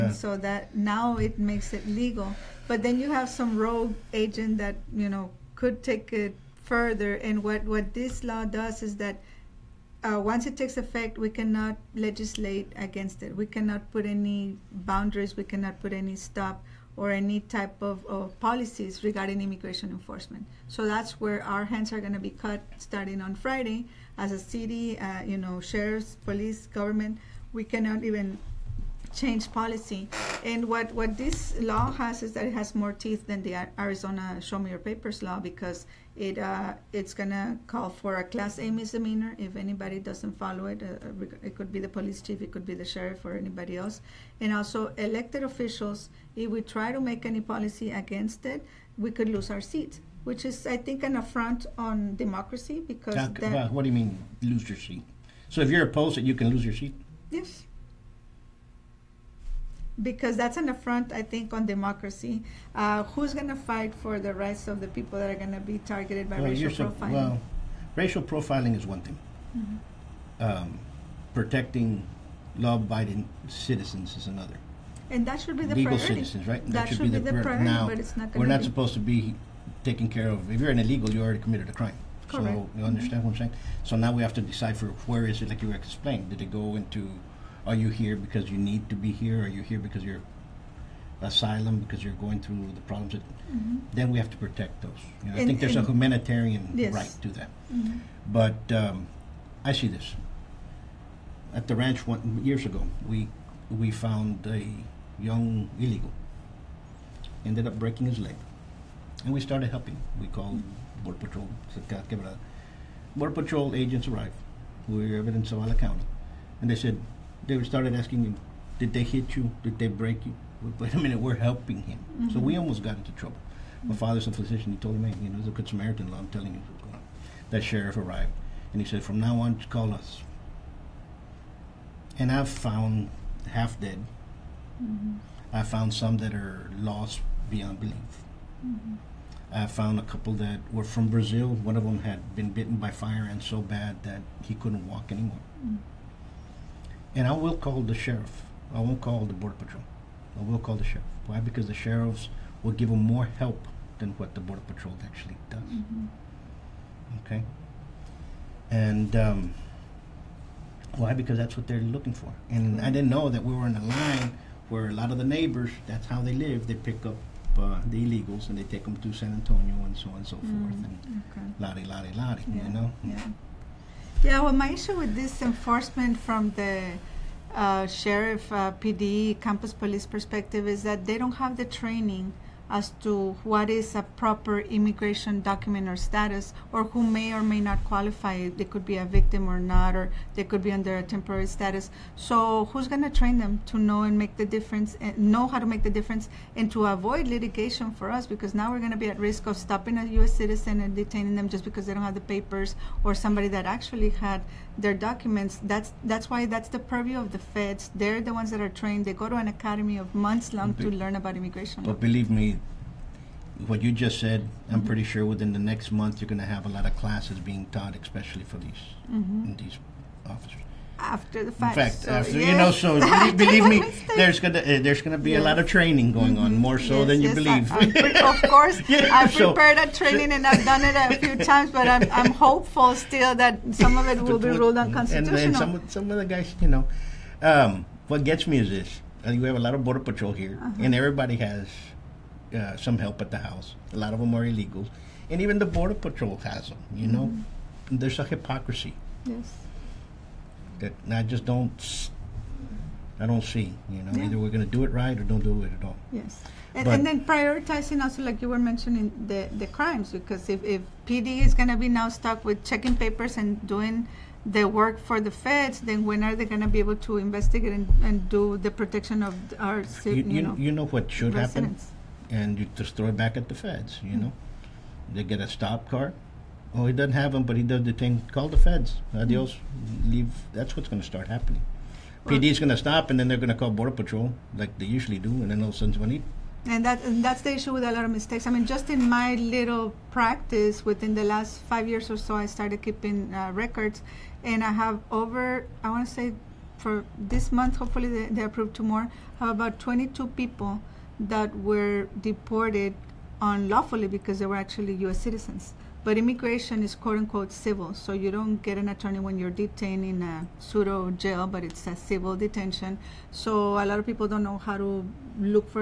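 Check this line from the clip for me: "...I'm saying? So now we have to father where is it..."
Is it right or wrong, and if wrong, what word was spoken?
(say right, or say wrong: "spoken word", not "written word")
wrong: "decipher", not "father".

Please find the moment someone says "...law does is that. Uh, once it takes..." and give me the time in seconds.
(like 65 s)
8 s.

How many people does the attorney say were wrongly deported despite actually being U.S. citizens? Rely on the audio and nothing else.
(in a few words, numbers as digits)
22.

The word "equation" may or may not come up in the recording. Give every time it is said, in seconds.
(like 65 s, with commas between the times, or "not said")
not said.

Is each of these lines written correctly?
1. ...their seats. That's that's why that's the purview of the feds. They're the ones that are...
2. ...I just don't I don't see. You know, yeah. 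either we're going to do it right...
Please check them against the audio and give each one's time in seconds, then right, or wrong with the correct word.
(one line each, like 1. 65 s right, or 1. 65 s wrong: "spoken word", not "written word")
1. 204 s wrong: "documents", not "seats"
2. 251 s right.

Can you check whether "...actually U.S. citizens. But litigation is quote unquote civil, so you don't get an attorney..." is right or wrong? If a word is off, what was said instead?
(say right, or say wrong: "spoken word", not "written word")
wrong: "immigration", not "litigation".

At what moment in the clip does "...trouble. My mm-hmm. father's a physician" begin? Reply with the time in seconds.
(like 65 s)
123 s.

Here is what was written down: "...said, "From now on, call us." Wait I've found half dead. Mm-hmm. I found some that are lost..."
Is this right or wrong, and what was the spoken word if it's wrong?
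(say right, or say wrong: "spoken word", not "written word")
wrong: "And", not "Wait".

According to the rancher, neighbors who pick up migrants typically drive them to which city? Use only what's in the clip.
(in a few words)
San Antonio.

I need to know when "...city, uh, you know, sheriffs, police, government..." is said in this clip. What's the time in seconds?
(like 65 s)
24 s.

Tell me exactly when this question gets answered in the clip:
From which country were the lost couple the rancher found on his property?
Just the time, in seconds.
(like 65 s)
141 s.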